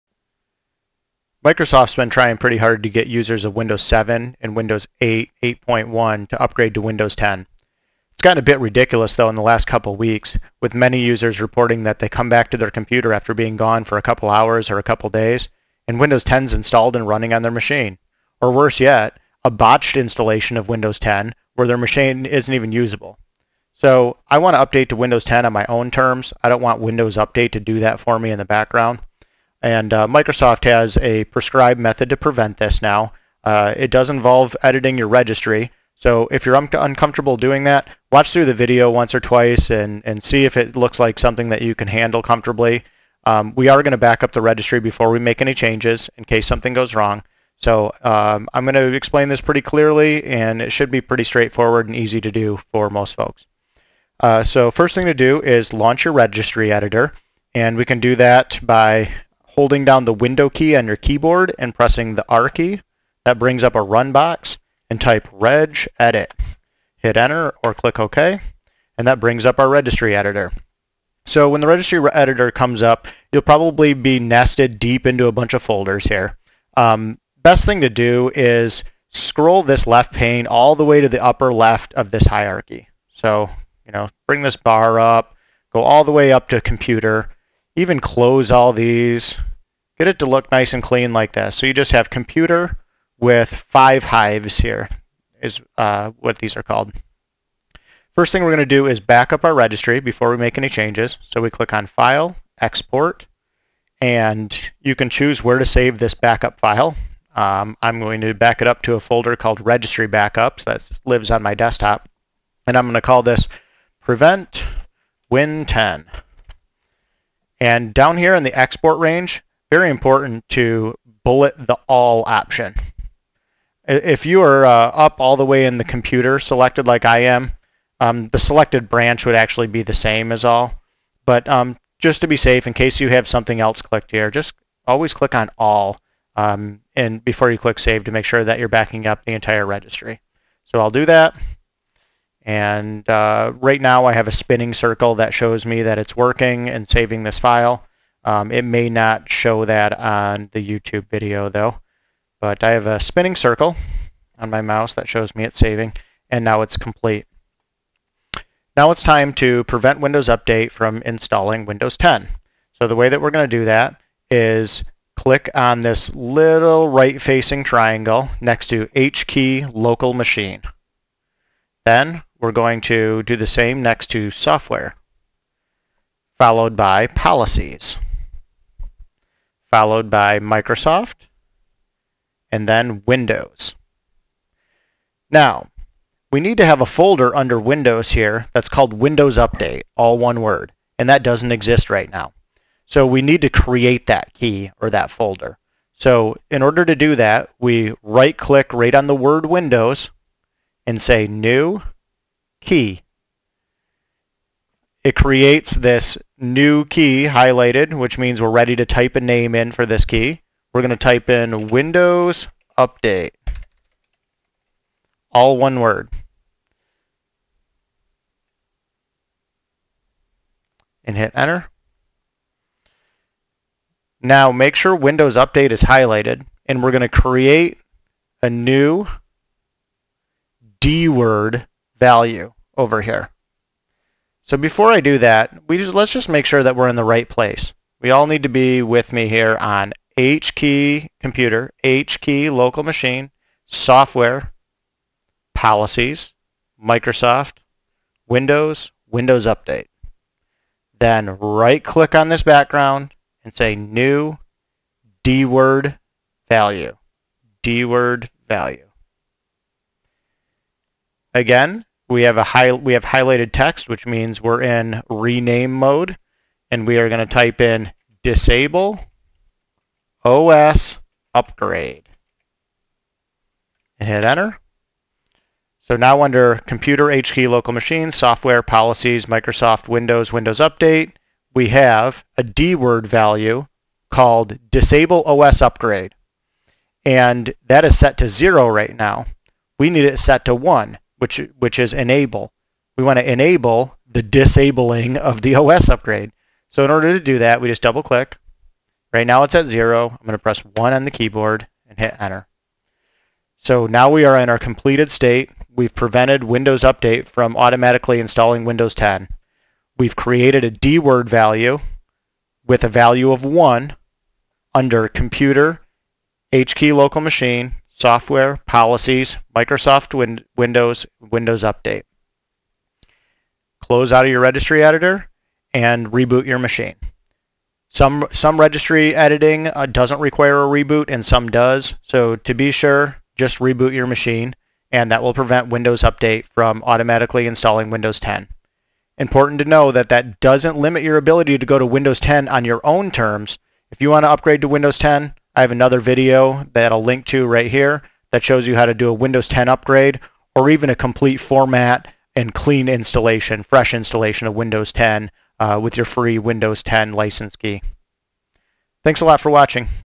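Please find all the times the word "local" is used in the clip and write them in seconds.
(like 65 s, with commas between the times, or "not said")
169 s, 242 s, 277 s, 316 s.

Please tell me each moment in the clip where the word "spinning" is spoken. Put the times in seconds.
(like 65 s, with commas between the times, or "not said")
144 s, 152 s.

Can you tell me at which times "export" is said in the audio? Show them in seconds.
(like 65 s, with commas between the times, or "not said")
102 s, 118 s.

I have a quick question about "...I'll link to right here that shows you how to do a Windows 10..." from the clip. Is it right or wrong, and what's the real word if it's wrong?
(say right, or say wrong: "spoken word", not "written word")
right.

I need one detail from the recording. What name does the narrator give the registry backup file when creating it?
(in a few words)
Prevent Win10.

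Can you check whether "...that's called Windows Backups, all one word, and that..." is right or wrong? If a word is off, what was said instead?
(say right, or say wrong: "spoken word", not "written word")
wrong: "Update", not "Backups".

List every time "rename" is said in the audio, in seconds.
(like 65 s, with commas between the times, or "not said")
265 s.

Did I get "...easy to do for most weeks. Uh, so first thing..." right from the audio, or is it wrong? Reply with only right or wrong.
wrong.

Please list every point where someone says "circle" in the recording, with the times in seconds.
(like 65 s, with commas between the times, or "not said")
144 s, 153 s.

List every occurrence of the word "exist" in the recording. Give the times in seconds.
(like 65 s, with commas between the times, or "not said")
191 s.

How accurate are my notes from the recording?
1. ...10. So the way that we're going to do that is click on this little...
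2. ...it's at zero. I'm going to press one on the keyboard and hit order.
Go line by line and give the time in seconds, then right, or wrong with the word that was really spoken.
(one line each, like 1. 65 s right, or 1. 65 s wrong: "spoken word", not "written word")
1. 161 s right
2. 299 s wrong: "enter", not "order".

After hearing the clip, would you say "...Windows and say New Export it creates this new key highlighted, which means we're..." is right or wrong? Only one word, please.
wrong.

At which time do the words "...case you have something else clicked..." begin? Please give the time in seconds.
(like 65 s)
132 s.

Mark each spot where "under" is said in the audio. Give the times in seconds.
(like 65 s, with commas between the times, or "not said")
187 s, 276 s, 314 s.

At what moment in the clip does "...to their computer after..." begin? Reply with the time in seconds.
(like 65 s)
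12 s.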